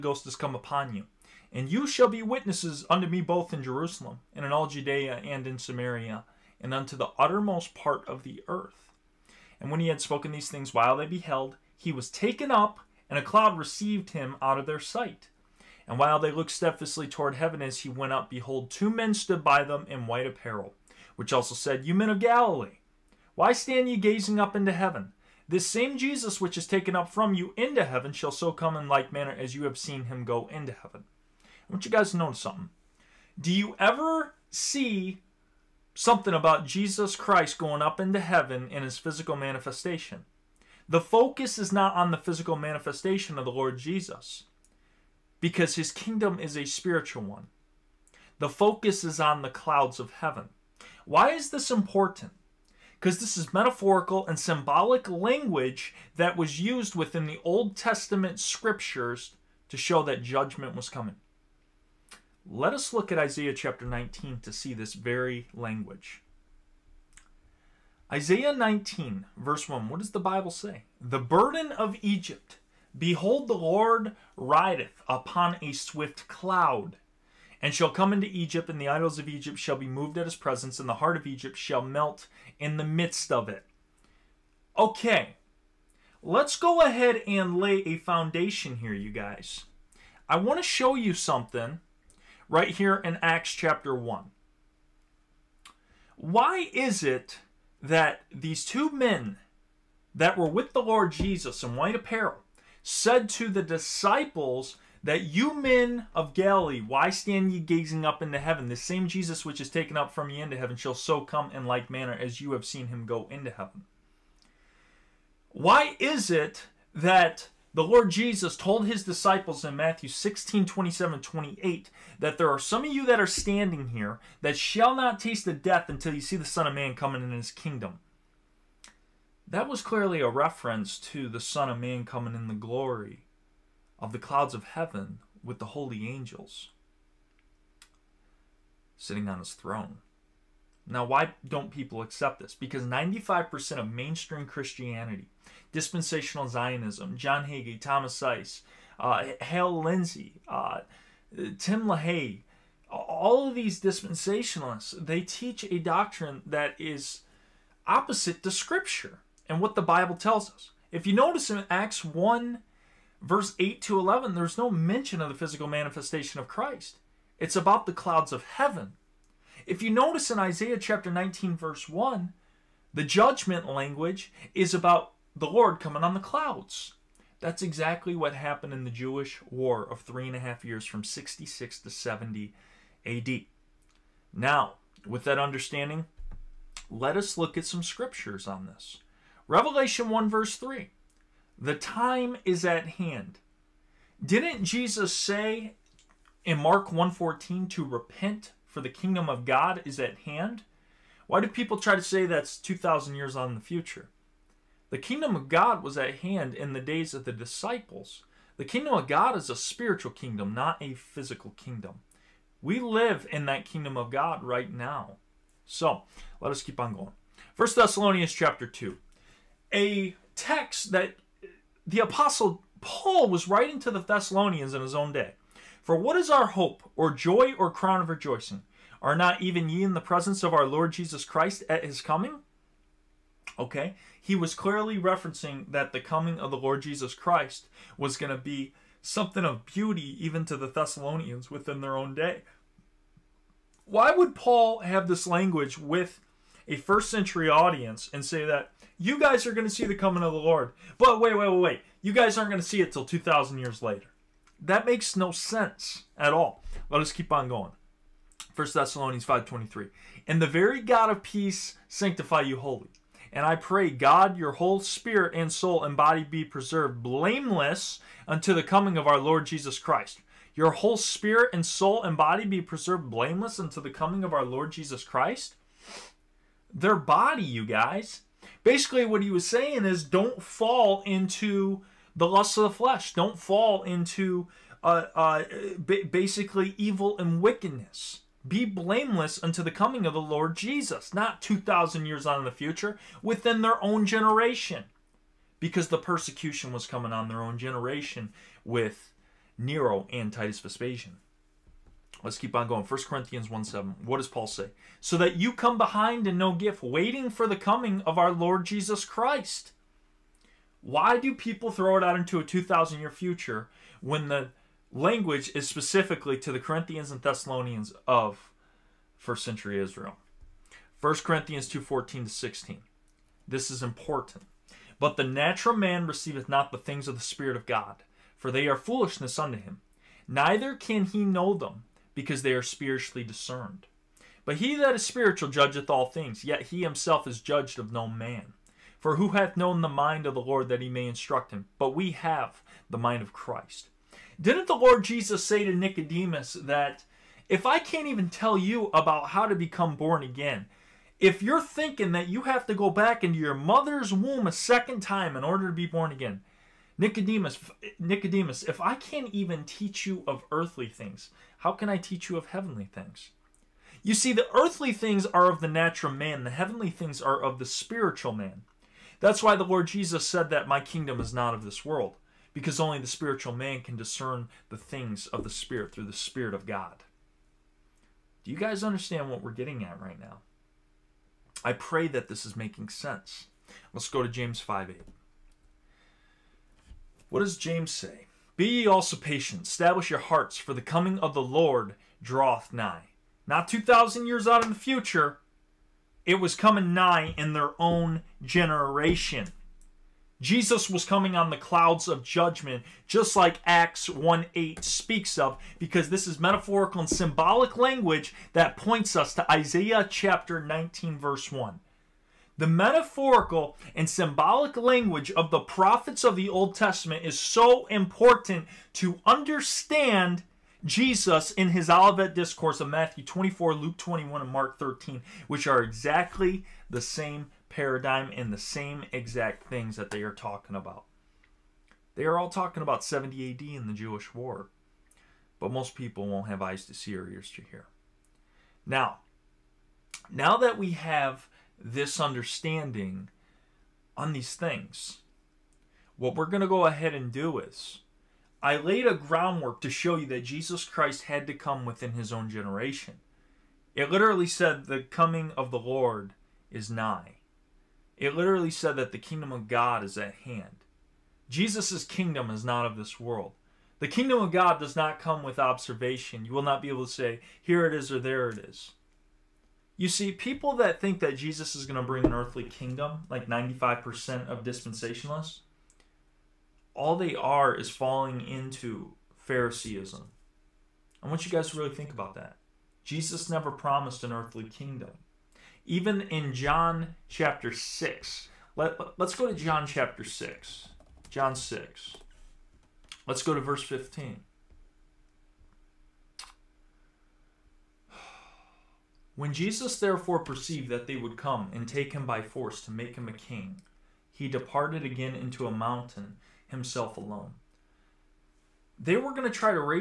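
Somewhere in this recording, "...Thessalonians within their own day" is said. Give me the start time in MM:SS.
04:00.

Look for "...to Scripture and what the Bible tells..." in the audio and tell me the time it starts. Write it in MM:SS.
02:38.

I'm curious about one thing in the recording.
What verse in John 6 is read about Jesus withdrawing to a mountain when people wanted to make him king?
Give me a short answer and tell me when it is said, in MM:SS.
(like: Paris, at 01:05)
Verse 15, at 08:13.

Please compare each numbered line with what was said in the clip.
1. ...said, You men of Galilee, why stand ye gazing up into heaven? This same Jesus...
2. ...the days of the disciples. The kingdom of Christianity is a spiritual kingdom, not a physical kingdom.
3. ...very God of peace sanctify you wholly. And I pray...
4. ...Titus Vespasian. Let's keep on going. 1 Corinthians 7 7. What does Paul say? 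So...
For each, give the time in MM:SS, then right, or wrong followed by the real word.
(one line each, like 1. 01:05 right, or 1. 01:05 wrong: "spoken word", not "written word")
1. 00:21 right
2. 03:26 wrong: "God", not "Christianity"
3. 04:20 right
4. 05:00 wrong: "1", not "7".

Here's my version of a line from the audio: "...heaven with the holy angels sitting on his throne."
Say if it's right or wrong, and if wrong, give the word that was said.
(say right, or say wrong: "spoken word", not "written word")
right.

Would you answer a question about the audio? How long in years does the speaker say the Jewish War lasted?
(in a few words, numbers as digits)
3.5 years.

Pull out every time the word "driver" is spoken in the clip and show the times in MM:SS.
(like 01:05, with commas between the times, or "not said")
not said.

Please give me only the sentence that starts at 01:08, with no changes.
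Isaiah 19, verse 1, what does the Bible say?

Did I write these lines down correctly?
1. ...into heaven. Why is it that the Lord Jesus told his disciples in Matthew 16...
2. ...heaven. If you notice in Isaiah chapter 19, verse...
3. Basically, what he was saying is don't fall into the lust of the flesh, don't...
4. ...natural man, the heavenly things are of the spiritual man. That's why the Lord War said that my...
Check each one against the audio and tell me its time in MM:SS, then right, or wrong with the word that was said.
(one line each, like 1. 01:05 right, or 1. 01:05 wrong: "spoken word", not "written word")
1. 01:53 right
2. 02:48 right
3. 04:38 right
4. 06:05 wrong: "Jesus", not "War".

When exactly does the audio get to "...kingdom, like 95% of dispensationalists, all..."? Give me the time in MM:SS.
07:52.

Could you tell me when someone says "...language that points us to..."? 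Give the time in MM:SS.
06:47.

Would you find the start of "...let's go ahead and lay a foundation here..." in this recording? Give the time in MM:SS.
01:26.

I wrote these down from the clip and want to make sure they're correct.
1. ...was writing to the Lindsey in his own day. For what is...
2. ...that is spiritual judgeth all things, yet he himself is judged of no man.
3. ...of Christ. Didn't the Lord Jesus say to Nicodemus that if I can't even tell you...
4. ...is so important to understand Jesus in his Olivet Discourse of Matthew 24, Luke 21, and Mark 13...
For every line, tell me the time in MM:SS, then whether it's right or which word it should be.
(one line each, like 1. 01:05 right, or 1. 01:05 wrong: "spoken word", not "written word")
1. 03:43 wrong: "Thessalonians", not "Lindsey"
2. 05:34 right
3. 05:43 right
4. 06:57 right.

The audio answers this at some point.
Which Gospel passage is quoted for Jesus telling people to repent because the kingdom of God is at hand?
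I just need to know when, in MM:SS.
03:16.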